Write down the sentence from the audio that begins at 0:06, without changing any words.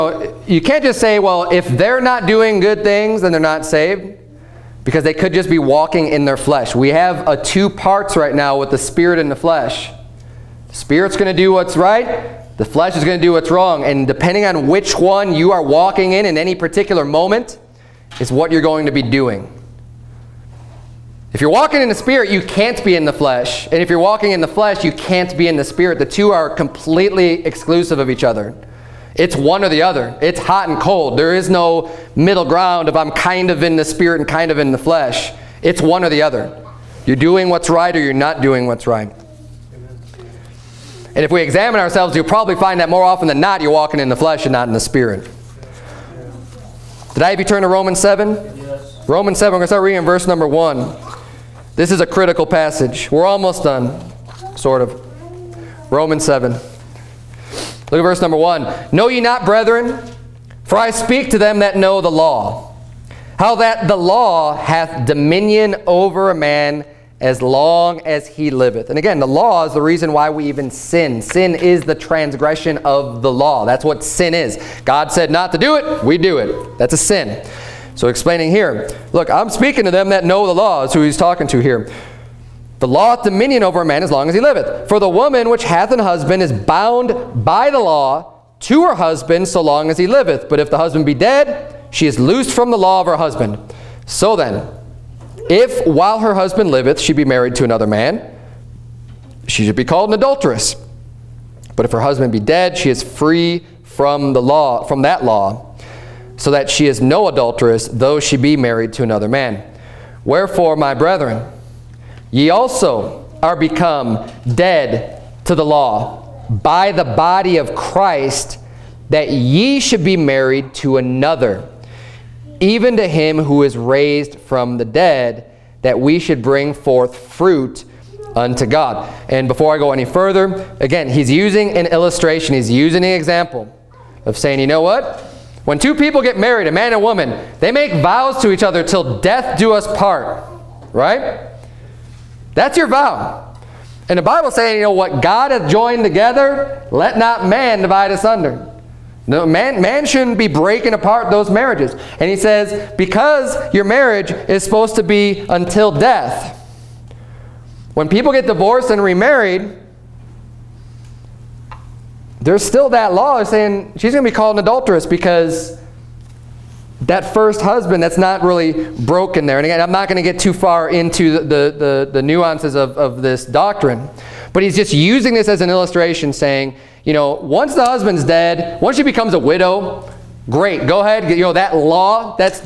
We have a two parts right now with the spirit and the flesh.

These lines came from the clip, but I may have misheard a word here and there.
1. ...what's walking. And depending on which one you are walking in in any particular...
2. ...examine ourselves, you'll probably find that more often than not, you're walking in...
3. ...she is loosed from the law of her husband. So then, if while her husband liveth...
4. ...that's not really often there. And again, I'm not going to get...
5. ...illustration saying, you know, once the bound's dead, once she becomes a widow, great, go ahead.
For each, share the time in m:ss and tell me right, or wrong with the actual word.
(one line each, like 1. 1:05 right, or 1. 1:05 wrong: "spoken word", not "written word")
1. 0:13 wrong: "wrong", not "walking"
2. 0:41 right
3. 1:31 right
4. 2:48 wrong: "broken", not "often"
5. 2:55 wrong: "husband", not "bound".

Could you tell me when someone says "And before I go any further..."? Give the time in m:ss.
2:09.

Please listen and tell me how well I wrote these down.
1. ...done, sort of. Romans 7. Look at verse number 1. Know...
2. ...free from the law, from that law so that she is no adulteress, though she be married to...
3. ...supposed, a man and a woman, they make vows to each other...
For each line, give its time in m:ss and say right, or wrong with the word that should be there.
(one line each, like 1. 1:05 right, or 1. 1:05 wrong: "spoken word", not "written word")
1. 0:53 right
2. 1:43 right
3. 2:16 wrong: "married", not "supposed".